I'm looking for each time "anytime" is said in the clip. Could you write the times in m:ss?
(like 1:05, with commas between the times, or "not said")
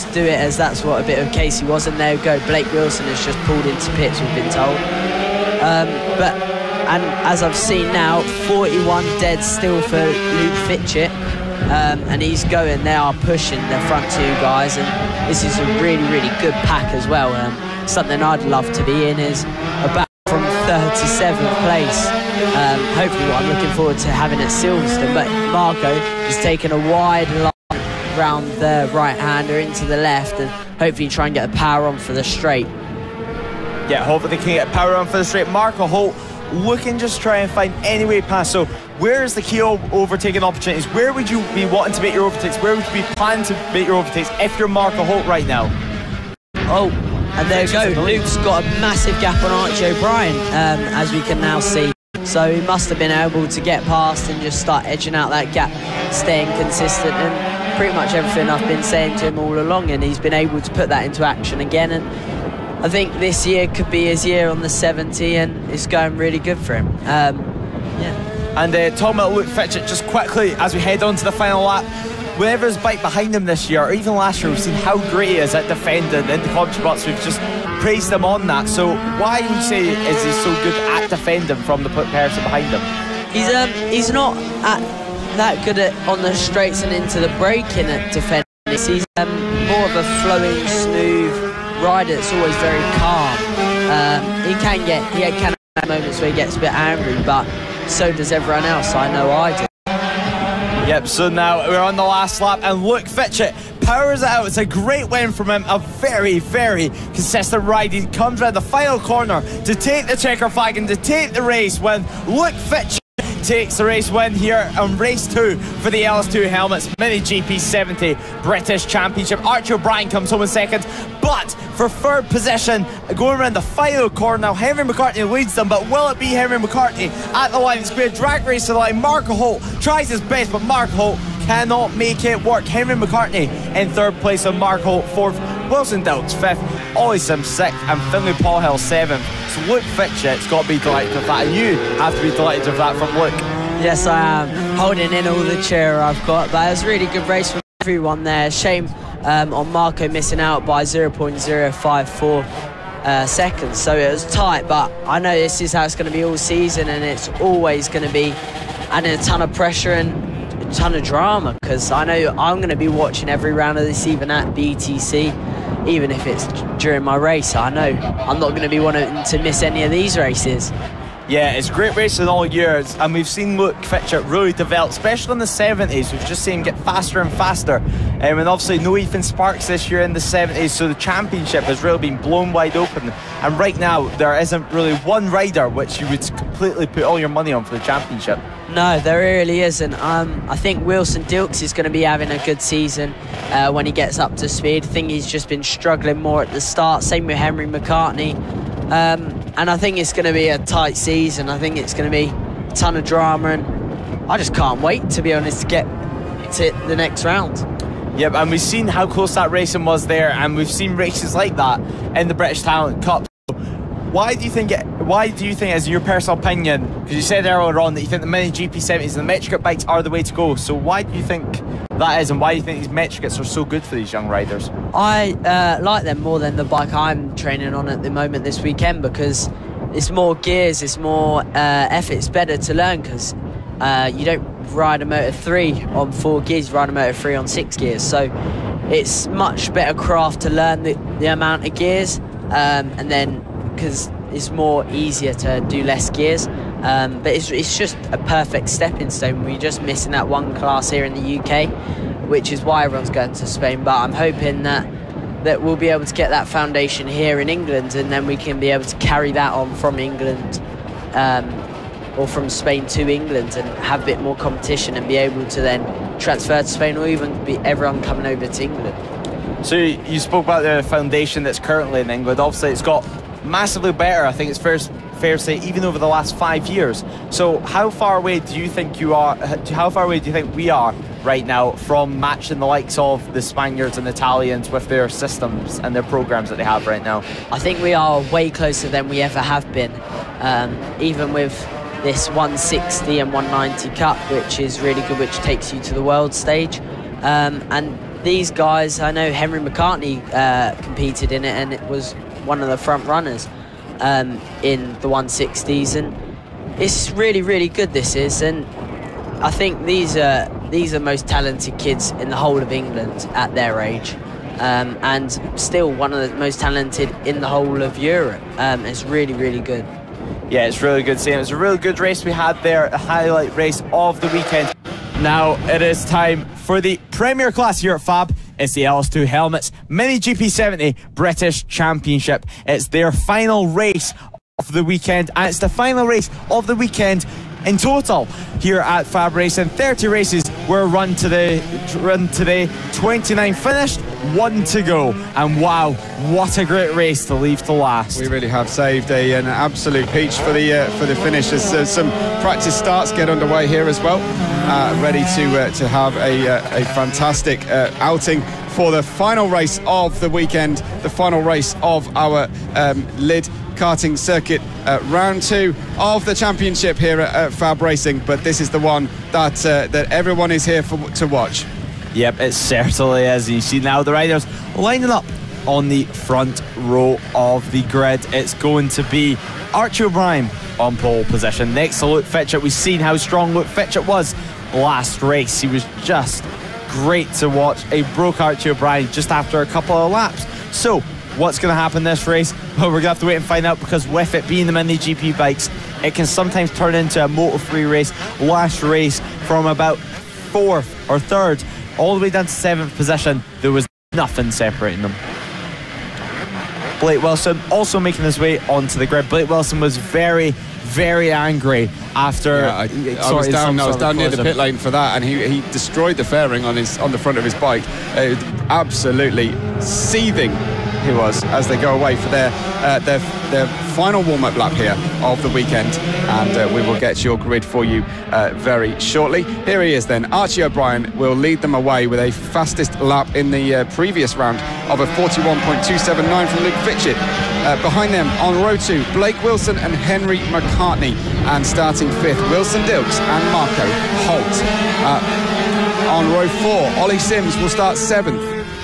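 not said.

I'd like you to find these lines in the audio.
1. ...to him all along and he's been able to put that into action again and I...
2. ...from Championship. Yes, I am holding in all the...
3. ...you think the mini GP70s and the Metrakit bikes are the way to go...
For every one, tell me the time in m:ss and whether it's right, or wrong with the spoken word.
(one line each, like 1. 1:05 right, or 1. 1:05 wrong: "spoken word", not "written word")
1. 0:59 right
2. 2:22 wrong: "Luke", not "Championship"
3. 3:38 right.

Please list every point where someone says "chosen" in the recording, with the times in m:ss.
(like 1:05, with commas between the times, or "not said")
not said.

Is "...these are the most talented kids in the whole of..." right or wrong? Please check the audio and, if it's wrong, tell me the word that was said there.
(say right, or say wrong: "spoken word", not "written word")
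right.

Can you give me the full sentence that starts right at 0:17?
Um, something I'd love to be in is about from 37th place.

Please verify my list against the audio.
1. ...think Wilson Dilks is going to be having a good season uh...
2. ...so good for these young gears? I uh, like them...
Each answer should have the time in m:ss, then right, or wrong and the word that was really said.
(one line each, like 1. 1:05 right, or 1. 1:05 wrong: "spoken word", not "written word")
1. 3:10 right
2. 3:43 wrong: "riders", not "gears".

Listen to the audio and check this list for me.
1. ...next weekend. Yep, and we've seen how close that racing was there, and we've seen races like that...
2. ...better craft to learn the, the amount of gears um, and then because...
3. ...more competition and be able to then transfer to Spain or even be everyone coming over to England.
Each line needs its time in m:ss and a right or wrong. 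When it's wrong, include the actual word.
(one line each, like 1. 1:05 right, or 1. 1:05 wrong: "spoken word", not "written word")
1. 3:26 wrong: "round", not "weekend"
2. 3:59 right
3. 4:24 right.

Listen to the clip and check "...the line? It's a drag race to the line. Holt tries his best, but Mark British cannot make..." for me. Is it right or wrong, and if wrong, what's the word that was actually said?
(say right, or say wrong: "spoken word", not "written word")
wrong: "Holt", not "British".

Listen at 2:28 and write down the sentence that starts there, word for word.
Shame um, on Marco missing out by 0.054.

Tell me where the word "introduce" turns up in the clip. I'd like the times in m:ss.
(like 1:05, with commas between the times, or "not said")
not said.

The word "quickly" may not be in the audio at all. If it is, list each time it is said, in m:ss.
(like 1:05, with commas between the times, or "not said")
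1:10.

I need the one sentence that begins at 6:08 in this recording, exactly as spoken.
But this is the one that uh, that everyone is here for to watch.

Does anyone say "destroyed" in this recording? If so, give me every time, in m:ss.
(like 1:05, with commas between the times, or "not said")
6:55.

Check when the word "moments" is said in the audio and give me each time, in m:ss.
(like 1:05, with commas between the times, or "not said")
1:35, 3:48.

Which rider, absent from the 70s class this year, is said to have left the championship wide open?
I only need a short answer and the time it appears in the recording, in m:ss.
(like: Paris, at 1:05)
Ethan Sparks, at 2:58.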